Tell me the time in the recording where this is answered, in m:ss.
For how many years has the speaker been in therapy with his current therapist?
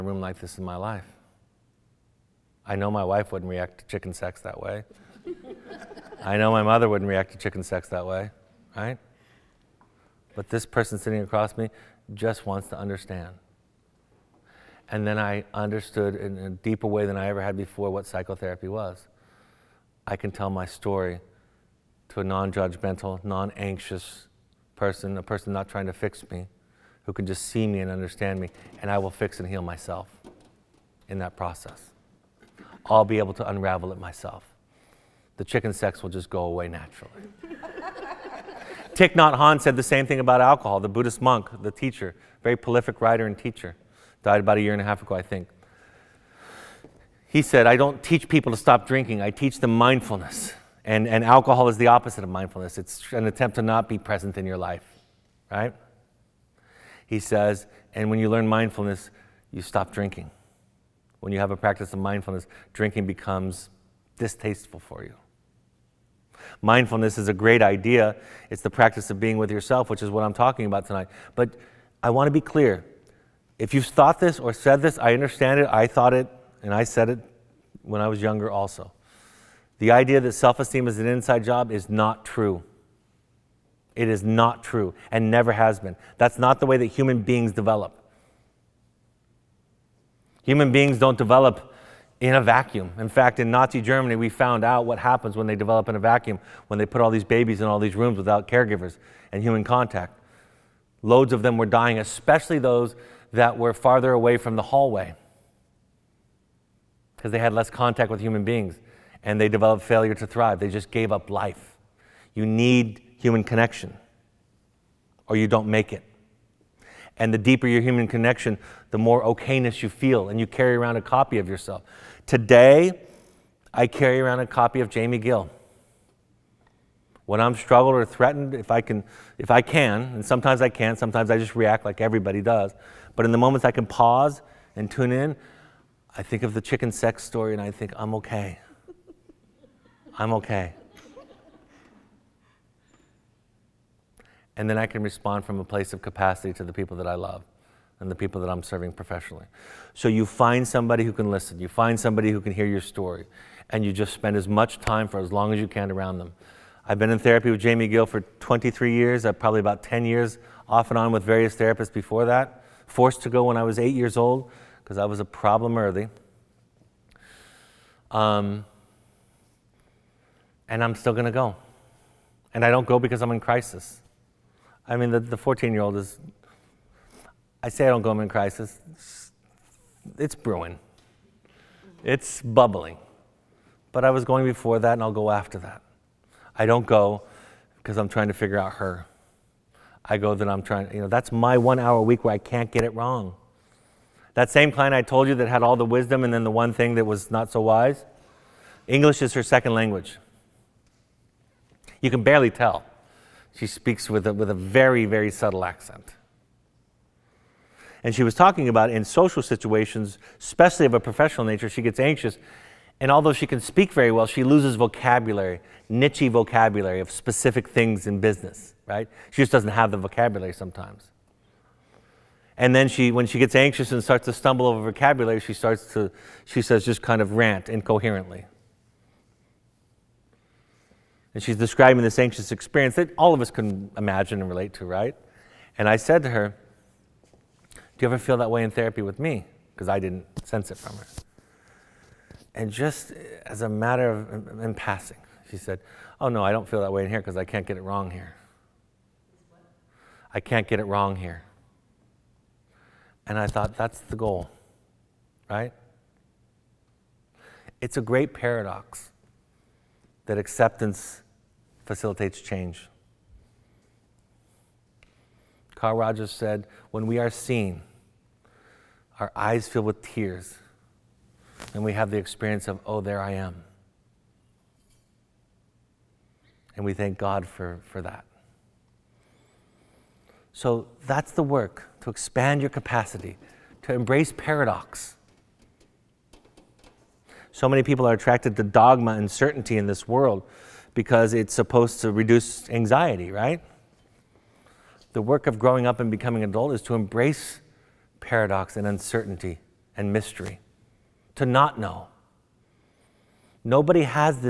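2:38.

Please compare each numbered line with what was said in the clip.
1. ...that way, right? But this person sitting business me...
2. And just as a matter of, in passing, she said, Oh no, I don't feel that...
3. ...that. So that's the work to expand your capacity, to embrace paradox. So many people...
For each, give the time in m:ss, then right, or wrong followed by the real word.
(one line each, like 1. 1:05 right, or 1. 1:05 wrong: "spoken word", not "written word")
1. 0:07 wrong: "across", not "business"
2. 4:02 right
3. 4:38 right.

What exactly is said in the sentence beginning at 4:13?
And I thought, that's the goal, right?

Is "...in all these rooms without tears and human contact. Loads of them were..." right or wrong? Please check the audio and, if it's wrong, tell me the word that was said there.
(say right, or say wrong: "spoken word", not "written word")
wrong: "caregivers", not "tears".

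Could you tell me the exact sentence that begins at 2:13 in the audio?
But in the moments I can pause and tune in, I think of the chicken sex story and I think, I'm okay.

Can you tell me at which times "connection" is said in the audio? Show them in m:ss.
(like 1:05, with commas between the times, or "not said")
1:53, 1:58.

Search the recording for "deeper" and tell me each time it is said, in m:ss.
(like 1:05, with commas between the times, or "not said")
0:16, 1:57.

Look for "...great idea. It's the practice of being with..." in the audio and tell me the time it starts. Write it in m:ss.
1:07.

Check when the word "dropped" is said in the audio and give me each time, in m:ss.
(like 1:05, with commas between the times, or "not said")
not said.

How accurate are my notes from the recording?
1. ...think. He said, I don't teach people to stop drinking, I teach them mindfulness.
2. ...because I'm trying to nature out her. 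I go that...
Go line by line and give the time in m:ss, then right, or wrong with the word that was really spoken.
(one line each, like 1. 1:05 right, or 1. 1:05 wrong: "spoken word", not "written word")
1. 0:45 right
2. 3:07 wrong: "figure", not "nature".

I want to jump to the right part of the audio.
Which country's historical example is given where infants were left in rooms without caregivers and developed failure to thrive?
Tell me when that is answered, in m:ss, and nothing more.
1:33.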